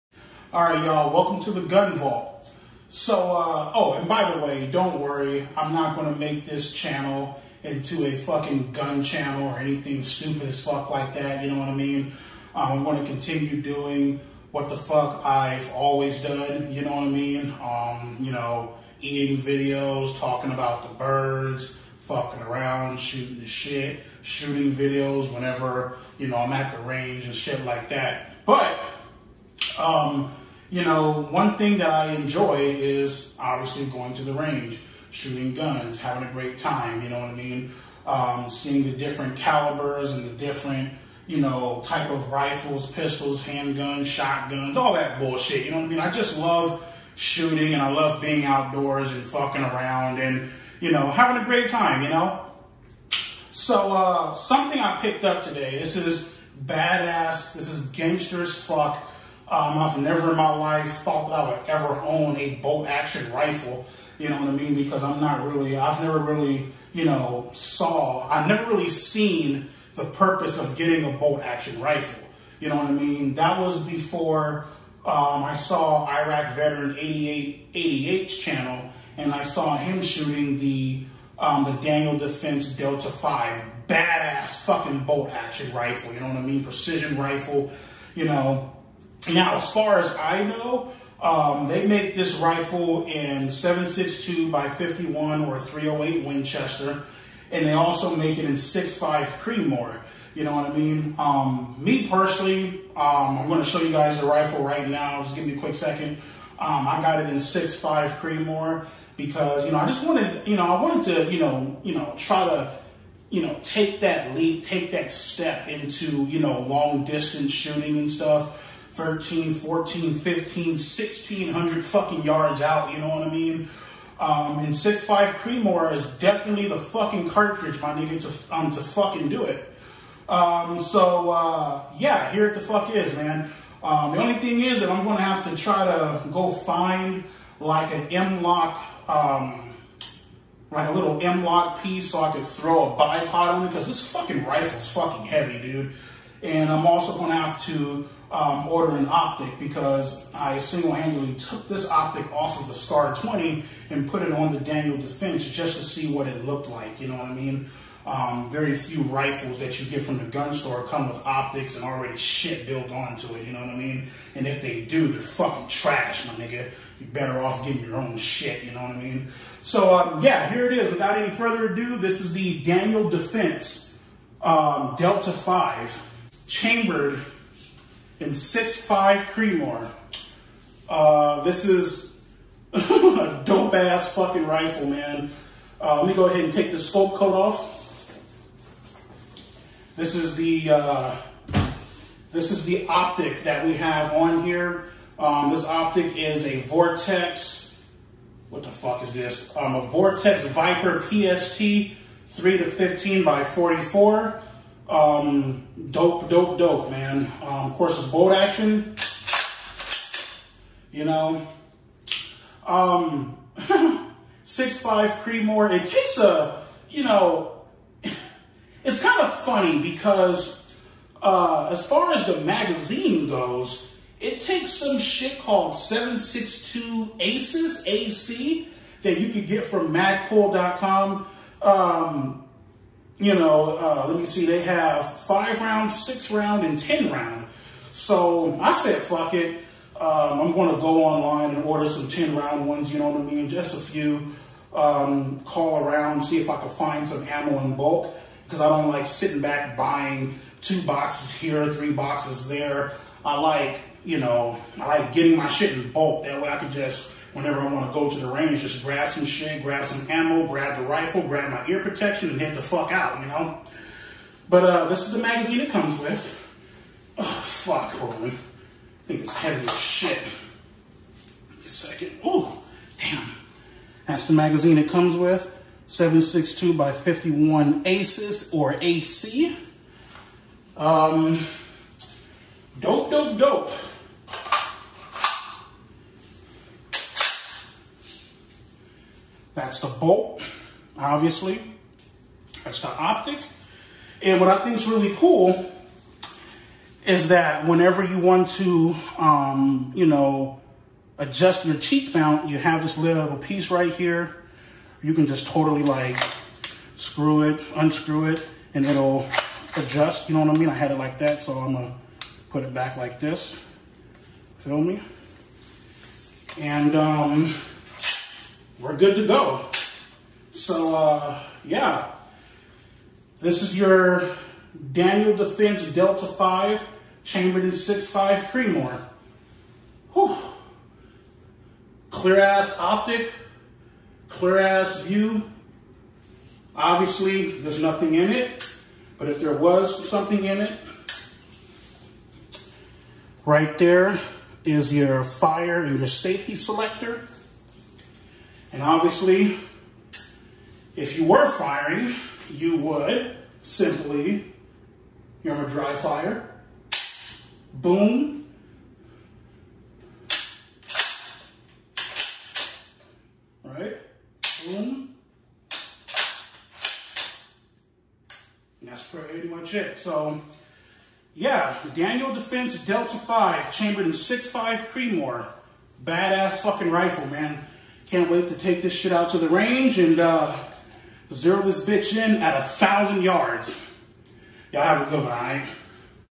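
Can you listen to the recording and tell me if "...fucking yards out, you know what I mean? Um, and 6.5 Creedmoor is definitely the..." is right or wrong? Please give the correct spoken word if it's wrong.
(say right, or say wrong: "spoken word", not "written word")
right.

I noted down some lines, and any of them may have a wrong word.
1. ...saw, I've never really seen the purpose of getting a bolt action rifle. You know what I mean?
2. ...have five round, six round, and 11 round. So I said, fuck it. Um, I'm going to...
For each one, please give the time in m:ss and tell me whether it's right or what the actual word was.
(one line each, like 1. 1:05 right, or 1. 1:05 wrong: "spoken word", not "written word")
1. 1:07 right
2. 3:54 wrong: "10", not "11".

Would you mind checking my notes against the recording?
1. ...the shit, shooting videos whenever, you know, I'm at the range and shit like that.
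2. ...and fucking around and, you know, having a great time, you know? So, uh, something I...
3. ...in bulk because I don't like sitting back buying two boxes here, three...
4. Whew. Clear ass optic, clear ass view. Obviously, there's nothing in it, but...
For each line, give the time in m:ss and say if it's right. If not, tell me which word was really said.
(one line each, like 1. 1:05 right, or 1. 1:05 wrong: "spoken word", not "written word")
1. 0:23 right
2. 0:49 right
3. 4:07 right
4. 5:30 right.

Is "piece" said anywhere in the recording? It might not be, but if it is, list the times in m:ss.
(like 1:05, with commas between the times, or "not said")
2:21, 5:03.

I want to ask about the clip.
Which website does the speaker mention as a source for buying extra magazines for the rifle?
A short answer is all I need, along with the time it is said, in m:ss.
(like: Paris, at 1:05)
Magpul.com, at 3:49.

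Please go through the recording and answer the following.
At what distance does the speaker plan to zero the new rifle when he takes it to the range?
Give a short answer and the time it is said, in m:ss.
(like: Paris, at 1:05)
1000 yards, at 6:22.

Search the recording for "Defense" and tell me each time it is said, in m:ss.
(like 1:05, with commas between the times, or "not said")
1:22, 2:34, 2:53, 5:25, 6:12.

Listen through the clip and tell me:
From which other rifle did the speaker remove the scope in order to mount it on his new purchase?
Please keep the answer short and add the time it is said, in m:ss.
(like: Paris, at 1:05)
Star 20, at 2:32.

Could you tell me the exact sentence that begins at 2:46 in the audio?
You're better off getting your own shit, you know what I mean?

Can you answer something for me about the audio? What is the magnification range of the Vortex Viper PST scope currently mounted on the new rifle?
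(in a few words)
3 to 15.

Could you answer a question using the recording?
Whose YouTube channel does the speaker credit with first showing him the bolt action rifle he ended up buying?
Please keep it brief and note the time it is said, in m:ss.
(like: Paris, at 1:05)
Iraq Veteran 8888, at 1:16.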